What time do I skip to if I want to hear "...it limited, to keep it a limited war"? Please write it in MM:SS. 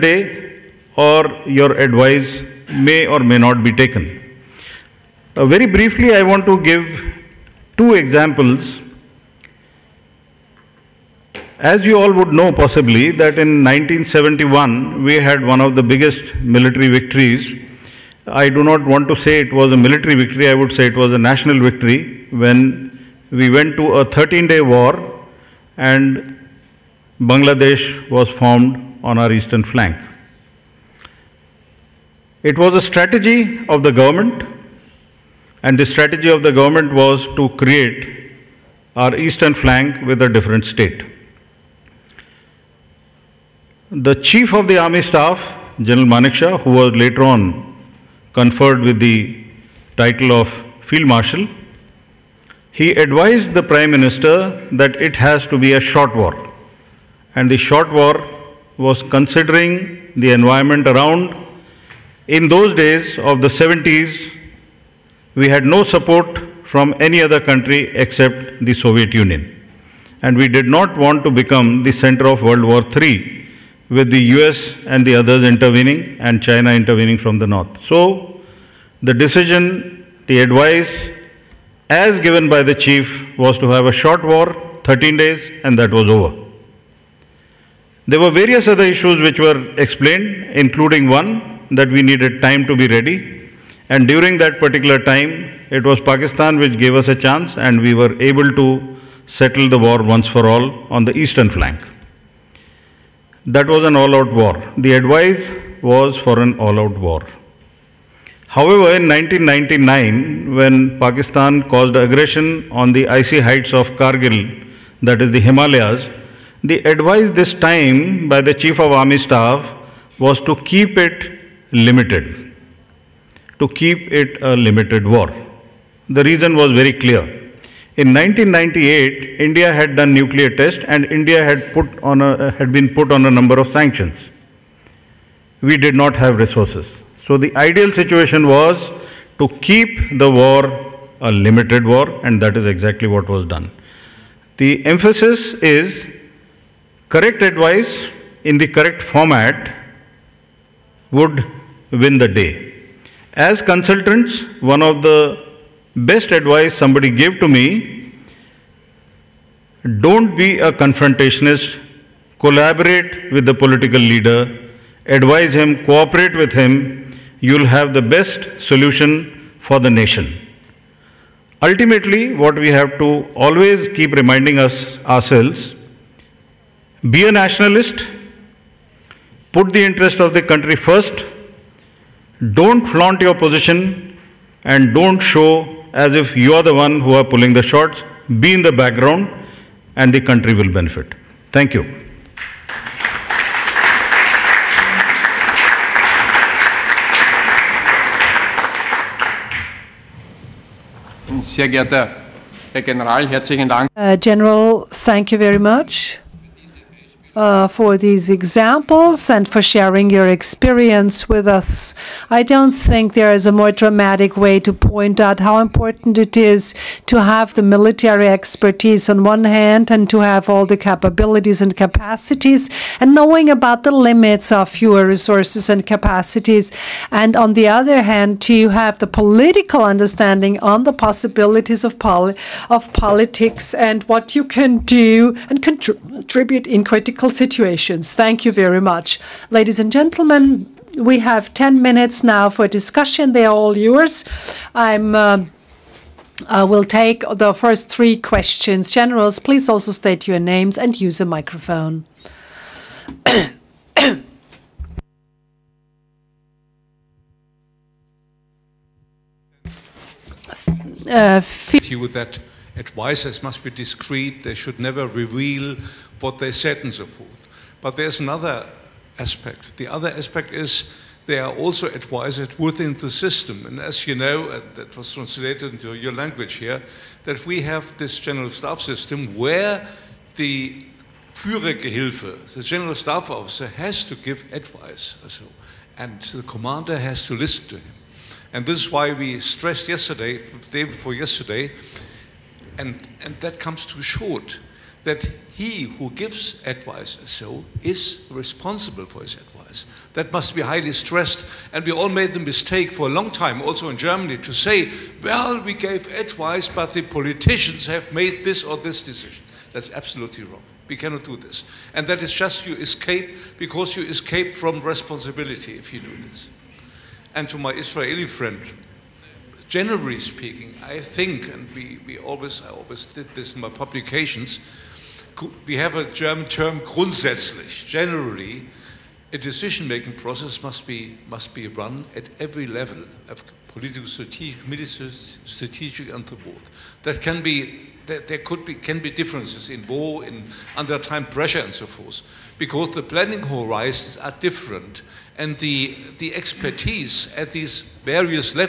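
02:00.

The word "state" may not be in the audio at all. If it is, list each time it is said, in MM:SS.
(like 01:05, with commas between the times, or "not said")
00:40, 04:09.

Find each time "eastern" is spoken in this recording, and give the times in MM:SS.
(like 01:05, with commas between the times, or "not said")
00:29, 00:39, 01:41.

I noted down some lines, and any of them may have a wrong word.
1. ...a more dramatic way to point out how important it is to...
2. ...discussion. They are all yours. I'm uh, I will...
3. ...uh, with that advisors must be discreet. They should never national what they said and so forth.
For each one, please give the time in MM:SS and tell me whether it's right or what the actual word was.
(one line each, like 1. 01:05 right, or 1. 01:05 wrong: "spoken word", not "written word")
1. 03:33 right
2. 04:02 right
3. 04:21 wrong: "reveal", not "national".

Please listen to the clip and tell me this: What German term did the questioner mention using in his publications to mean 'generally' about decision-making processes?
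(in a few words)
grundsätzlich.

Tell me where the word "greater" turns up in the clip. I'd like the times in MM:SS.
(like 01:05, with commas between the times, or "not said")
not said.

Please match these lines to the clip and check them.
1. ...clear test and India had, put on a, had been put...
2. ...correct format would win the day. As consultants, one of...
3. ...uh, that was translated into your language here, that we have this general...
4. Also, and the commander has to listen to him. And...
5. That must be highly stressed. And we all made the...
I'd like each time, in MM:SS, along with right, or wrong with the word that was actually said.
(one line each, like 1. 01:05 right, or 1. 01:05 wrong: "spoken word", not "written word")
1. 02:10 wrong: "nuclear", not "clear"
2. 02:28 right
3. 04:34 right
4. 04:45 right
5. 05:00 right.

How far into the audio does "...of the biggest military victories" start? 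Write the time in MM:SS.
00:15.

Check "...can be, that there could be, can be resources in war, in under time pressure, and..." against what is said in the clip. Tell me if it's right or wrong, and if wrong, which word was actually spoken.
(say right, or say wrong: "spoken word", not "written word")
wrong: "differences", not "resources".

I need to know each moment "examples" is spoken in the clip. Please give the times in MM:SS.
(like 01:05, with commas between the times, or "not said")
00:07, 03:28.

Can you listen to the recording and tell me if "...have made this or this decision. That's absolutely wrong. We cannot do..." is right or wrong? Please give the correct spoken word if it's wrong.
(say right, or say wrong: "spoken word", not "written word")
right.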